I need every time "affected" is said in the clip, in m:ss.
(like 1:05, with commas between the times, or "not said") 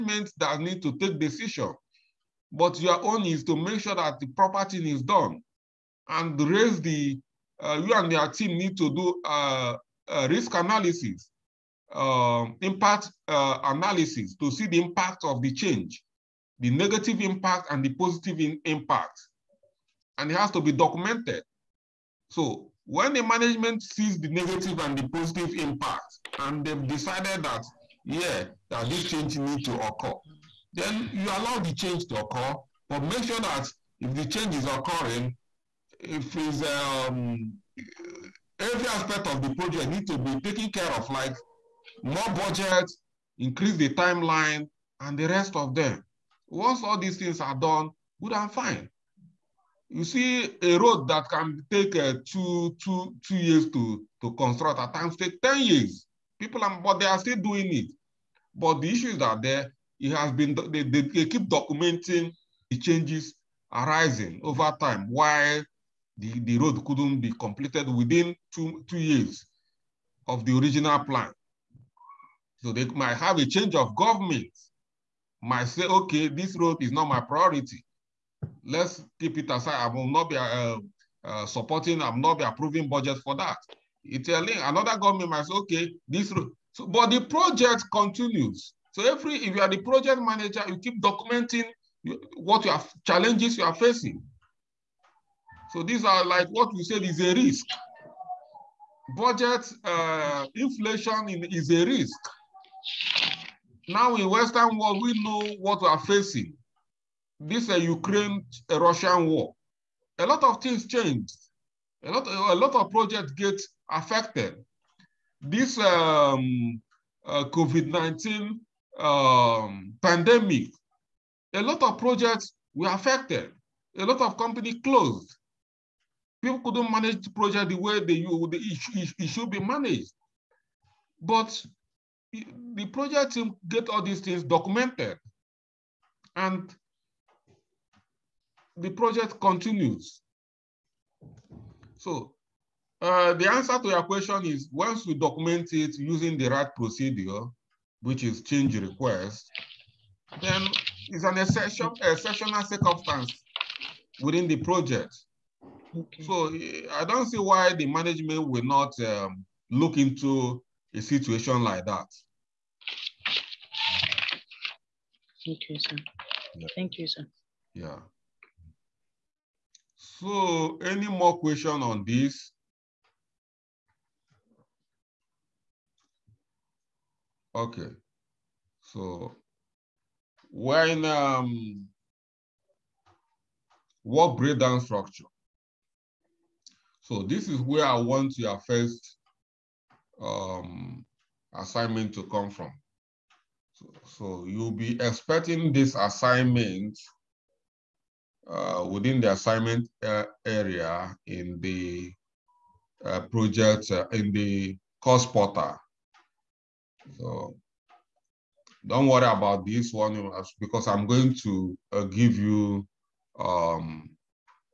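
1:53, 2:02.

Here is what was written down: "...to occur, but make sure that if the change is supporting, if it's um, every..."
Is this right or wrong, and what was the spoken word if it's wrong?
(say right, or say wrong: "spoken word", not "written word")
wrong: "occurring", not "supporting".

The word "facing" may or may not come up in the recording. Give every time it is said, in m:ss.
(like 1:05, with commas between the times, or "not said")
1:33, 1:46.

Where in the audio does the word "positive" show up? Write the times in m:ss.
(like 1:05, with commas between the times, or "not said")
0:17, 0:25.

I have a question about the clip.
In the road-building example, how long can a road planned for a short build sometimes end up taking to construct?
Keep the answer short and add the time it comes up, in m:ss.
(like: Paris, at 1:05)
10 years, at 0:55.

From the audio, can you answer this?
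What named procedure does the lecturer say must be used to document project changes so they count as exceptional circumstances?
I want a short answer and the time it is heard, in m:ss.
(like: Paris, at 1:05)
Change request, at 2:28.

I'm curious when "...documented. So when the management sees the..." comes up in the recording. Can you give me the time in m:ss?
0:20.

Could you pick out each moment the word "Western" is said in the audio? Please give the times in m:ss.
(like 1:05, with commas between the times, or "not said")
1:44.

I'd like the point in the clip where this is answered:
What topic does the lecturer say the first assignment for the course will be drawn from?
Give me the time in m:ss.
3:04.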